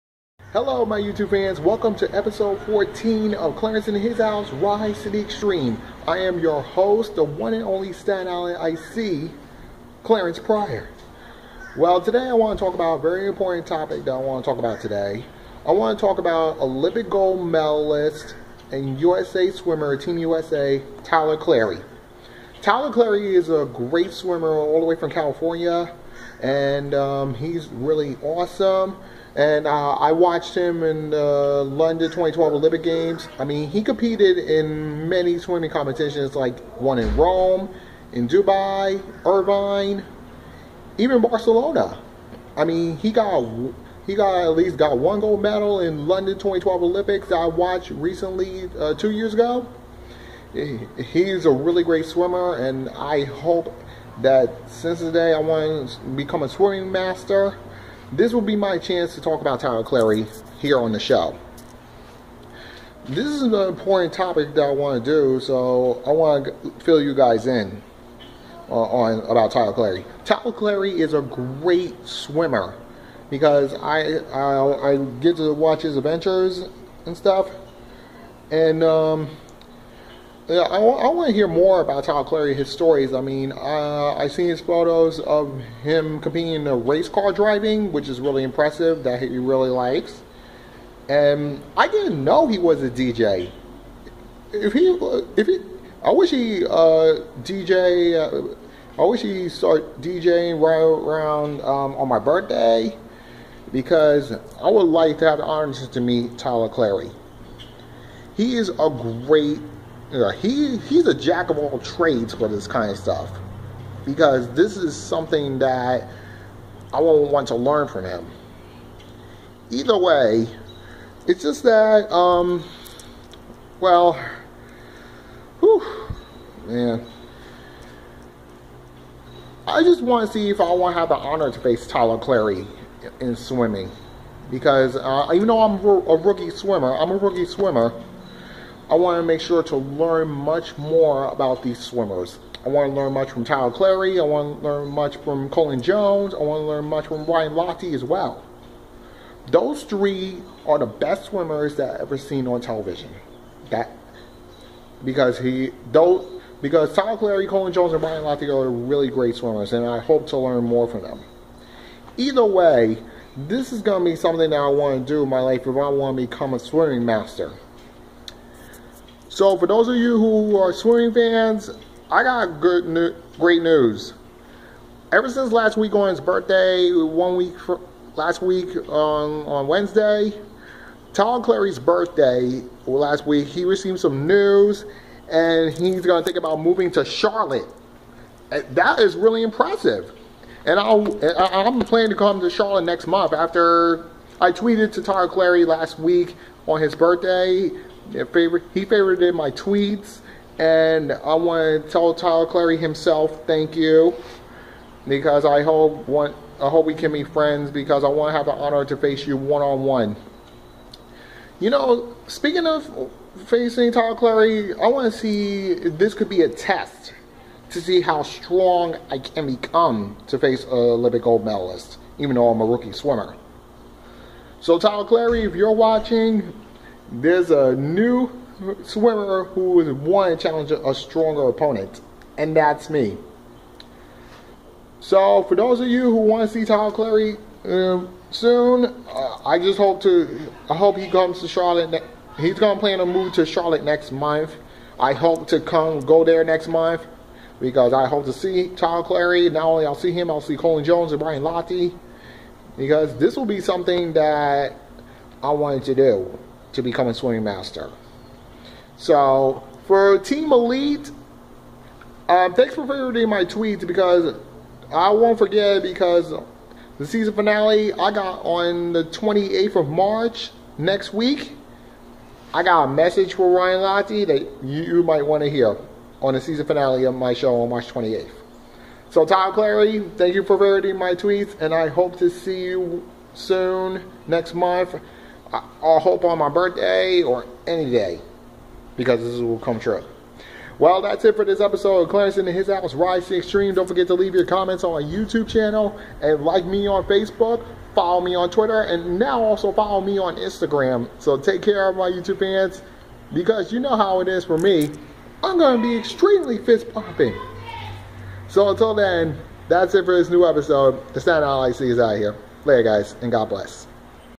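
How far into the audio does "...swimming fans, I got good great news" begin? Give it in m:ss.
2:50.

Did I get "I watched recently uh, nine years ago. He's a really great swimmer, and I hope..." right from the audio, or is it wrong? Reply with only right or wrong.
wrong.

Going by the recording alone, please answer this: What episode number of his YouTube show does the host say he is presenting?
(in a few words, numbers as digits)
14.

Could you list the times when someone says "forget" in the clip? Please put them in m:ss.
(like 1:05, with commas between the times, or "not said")
4:25, 4:53.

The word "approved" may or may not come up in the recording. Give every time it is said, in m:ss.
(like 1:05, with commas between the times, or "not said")
not said.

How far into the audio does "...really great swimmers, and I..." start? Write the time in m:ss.
2:38.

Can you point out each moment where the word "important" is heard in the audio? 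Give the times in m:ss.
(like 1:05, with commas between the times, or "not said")
0:13, 1:03.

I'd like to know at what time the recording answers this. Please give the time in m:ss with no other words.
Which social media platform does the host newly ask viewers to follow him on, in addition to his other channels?
5:00.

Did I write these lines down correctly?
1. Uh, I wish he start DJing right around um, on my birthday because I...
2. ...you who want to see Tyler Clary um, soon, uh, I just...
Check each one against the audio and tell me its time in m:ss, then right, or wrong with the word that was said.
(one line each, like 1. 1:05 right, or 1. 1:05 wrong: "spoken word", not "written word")
1. 1:38 right
2. 3:55 right.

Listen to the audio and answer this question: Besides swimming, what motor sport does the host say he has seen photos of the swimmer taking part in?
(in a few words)
Race car driving.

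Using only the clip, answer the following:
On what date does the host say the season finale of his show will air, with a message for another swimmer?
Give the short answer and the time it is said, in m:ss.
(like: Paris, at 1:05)
March 28, at 4:37.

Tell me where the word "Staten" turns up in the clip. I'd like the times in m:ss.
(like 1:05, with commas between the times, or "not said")
0:07.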